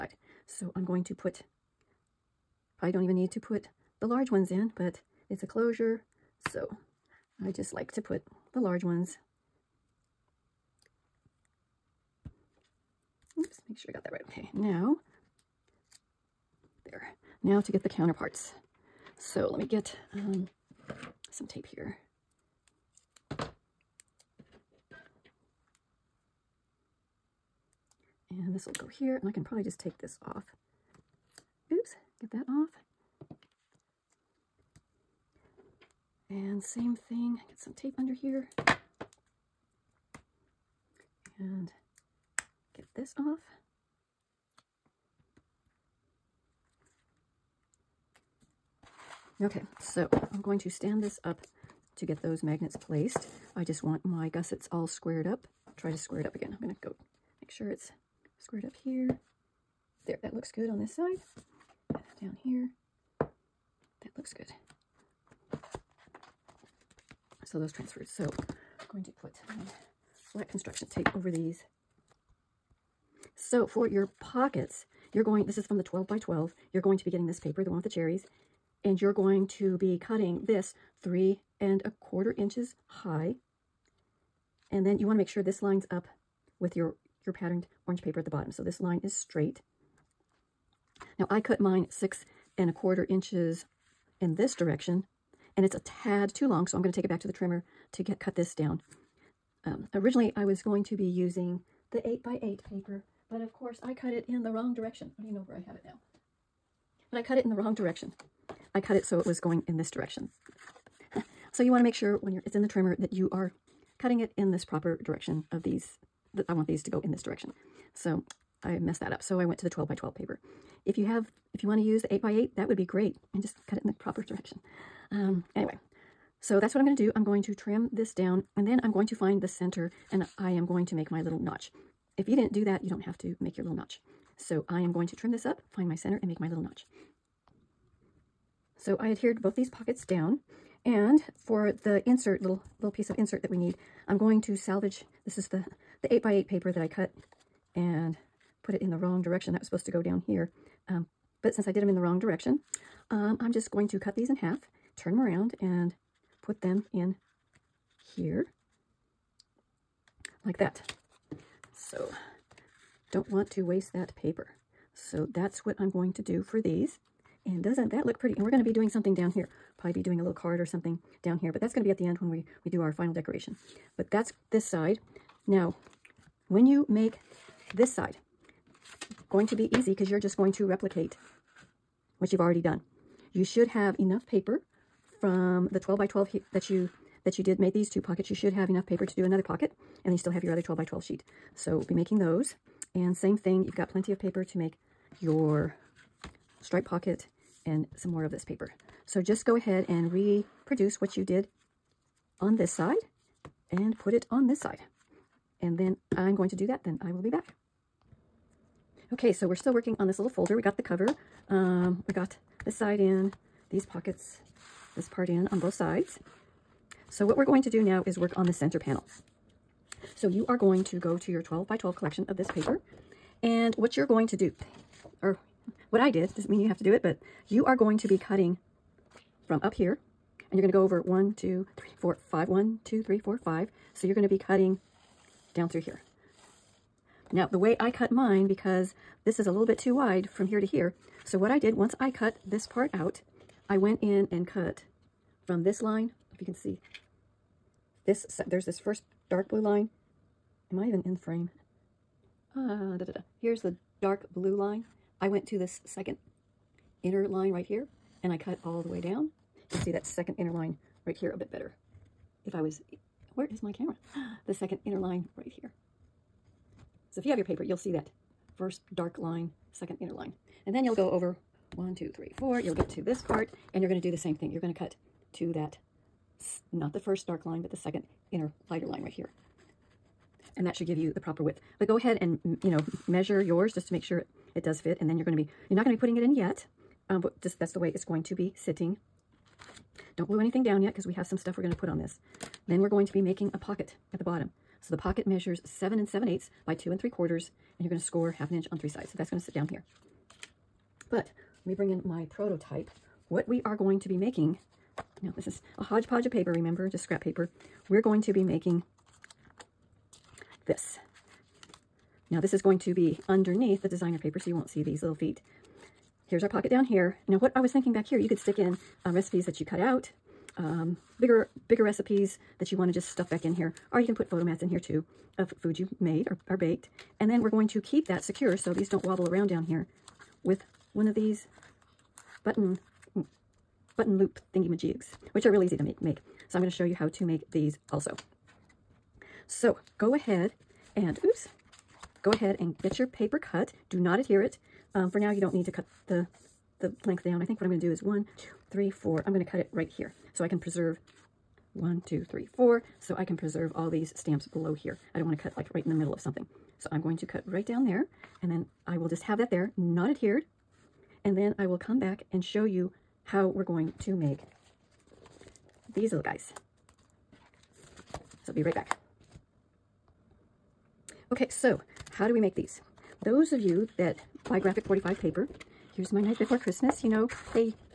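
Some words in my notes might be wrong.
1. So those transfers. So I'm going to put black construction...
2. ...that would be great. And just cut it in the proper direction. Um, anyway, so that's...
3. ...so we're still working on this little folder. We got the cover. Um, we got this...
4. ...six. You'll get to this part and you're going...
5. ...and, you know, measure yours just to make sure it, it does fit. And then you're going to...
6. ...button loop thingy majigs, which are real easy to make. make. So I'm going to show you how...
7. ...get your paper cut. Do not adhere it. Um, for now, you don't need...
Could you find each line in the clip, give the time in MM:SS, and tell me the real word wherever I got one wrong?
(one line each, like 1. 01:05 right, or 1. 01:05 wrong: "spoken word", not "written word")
1. 01:07 right
2. 02:02 right
3. 03:29 right
4. 04:32 wrong: "four", not "six"
5. 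04:42 right
6. 05:33 right
7. 05:42 right.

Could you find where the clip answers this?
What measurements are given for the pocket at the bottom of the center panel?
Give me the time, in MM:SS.
04:55.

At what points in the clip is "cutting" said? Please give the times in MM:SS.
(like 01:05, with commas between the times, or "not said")
01:19, 01:53, 03:48, 03:54.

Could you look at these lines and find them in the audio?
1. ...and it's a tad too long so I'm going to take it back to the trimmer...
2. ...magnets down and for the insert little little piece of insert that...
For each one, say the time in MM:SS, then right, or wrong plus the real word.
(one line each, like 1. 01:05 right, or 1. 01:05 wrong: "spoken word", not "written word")
1. 01:35 right
2. 02:19 wrong: "pockets", not "magnets".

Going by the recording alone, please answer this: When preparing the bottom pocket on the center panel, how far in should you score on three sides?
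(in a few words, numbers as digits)
half an inch.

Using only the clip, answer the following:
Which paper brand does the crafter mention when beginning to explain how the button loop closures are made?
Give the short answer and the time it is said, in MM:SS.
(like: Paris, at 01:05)
Graphic 45, at 06:14.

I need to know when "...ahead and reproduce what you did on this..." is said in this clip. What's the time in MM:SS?
03:19.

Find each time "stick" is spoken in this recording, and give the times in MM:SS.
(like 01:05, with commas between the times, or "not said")
05:18.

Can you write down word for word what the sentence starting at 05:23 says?
Or you can put photo mats in here too of food you made or, or baked.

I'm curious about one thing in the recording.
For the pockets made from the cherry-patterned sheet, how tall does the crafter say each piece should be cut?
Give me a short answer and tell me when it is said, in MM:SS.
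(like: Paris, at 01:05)
3 1/4 inches, at 01:21.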